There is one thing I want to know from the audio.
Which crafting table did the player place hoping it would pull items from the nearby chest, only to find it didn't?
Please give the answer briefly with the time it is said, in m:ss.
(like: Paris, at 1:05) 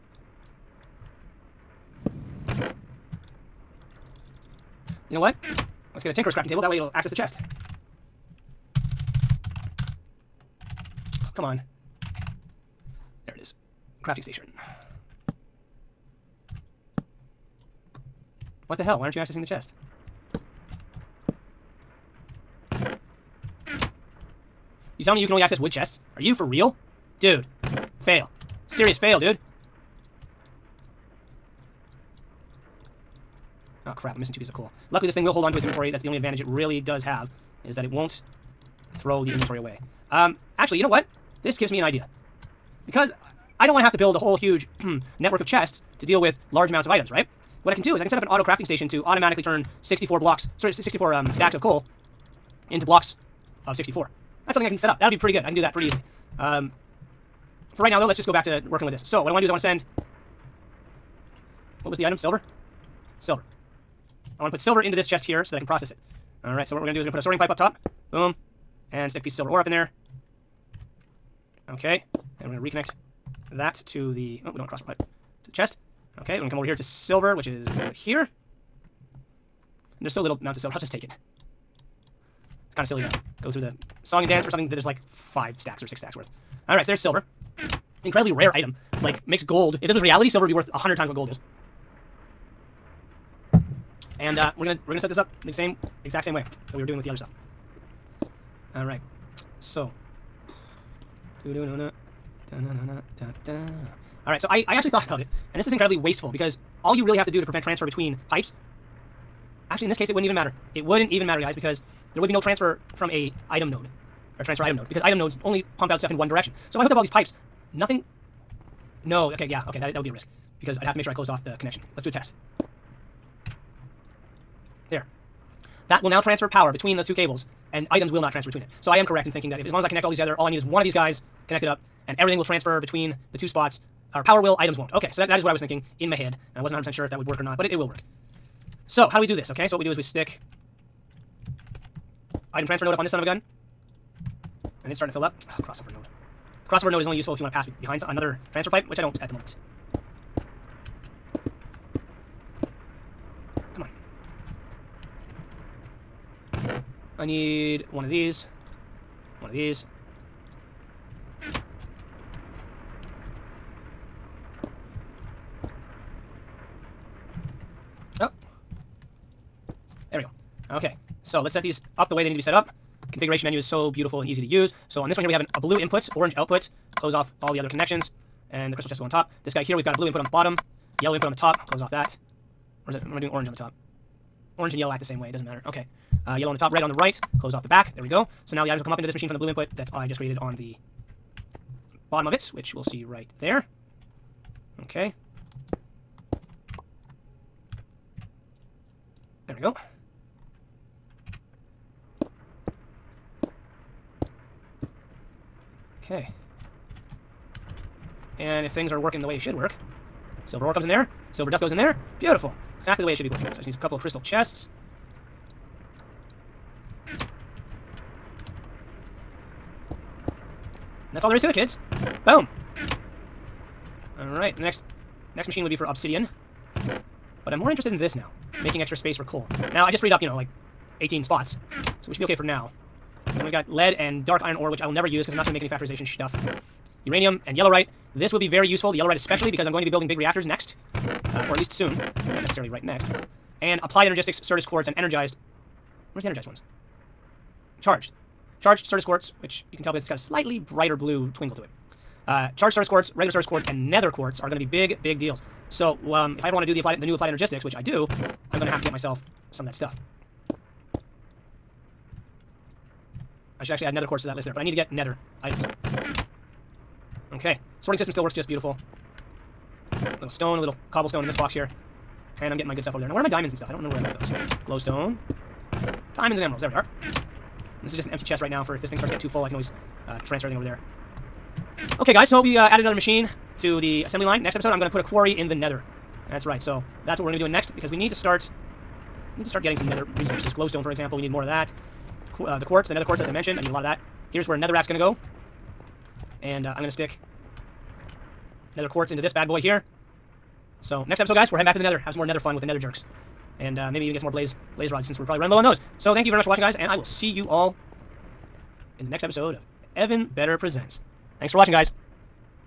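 Tinkerer's crafting table, at 0:06.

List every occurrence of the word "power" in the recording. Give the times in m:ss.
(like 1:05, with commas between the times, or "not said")
2:06, 2:14.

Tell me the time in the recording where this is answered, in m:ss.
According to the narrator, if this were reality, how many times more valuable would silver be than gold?
1:30.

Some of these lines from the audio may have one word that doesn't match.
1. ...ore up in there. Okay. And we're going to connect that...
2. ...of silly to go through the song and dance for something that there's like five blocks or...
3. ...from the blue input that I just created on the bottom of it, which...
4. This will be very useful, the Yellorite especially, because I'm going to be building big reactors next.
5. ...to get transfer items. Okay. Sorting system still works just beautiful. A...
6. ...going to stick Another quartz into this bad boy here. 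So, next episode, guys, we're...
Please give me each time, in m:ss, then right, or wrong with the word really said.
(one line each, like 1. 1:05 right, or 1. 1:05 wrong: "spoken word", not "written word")
1. 1:09 wrong: "reconnect", not "connect"
2. 1:22 wrong: "stacks", not "blocks"
3. 3:09 right
4. 3:58 right
5. 4:24 wrong: "nether", not "transfer"
6. 4:56 right.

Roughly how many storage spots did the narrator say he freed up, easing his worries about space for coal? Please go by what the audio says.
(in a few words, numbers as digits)
18.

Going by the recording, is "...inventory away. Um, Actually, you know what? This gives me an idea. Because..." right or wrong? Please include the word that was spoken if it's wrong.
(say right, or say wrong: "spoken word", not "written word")
right.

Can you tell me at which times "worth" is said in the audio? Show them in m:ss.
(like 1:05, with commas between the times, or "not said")
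1:26, 1:30.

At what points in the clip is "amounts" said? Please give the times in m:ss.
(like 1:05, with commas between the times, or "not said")
0:46, 1:20.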